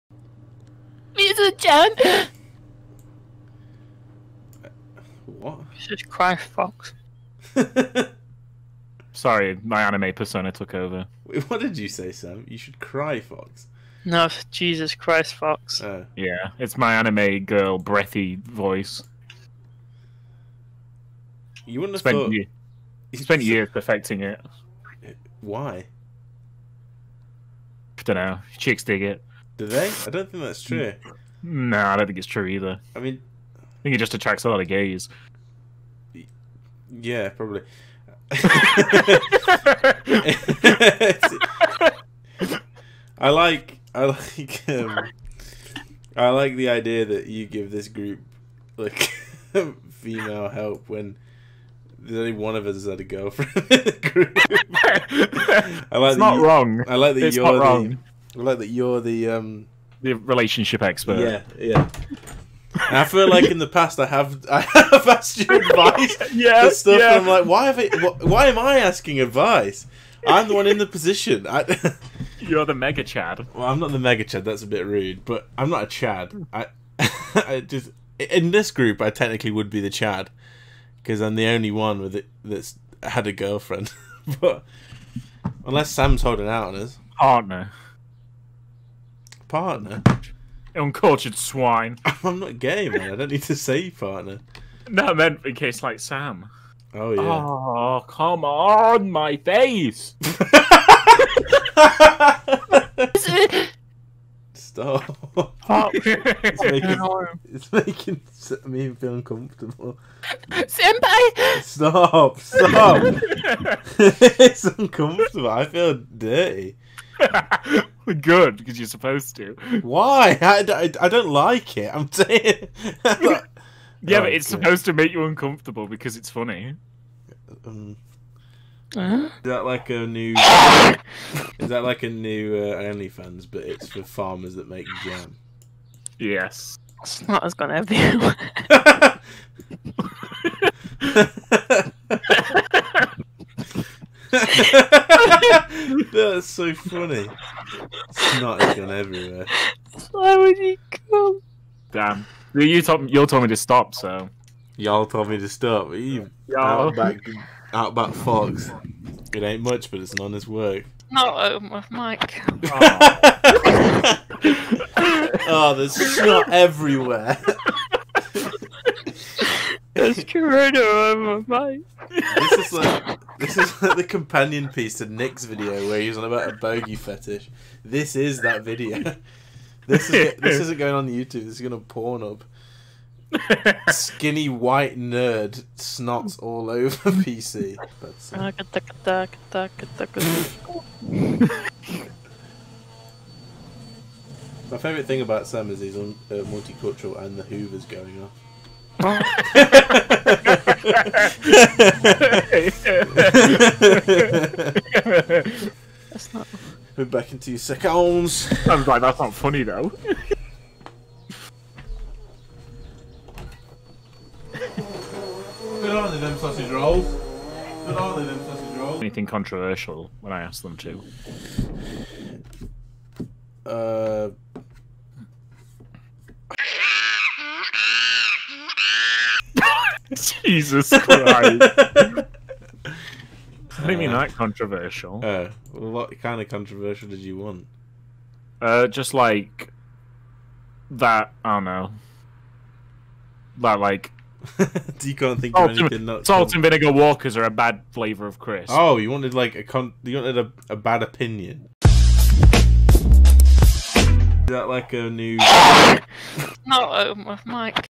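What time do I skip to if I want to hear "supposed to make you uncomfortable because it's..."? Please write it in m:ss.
2:04.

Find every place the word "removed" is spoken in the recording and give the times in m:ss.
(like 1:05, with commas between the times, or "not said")
not said.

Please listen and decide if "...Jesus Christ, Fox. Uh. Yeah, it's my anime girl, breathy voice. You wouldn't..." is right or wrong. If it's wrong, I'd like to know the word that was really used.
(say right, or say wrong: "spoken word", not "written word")
right.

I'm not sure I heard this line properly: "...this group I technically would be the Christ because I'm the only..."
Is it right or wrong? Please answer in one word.
wrong.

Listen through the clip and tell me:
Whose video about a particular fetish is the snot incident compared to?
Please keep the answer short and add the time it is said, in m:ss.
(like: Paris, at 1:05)
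Nick, at 2:55.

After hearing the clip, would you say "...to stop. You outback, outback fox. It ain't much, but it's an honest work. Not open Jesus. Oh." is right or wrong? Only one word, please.
wrong.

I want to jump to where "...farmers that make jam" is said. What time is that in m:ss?
2:14.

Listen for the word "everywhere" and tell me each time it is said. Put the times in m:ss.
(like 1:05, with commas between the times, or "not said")
2:28, 2:46.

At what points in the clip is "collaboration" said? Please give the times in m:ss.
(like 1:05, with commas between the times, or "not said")
not said.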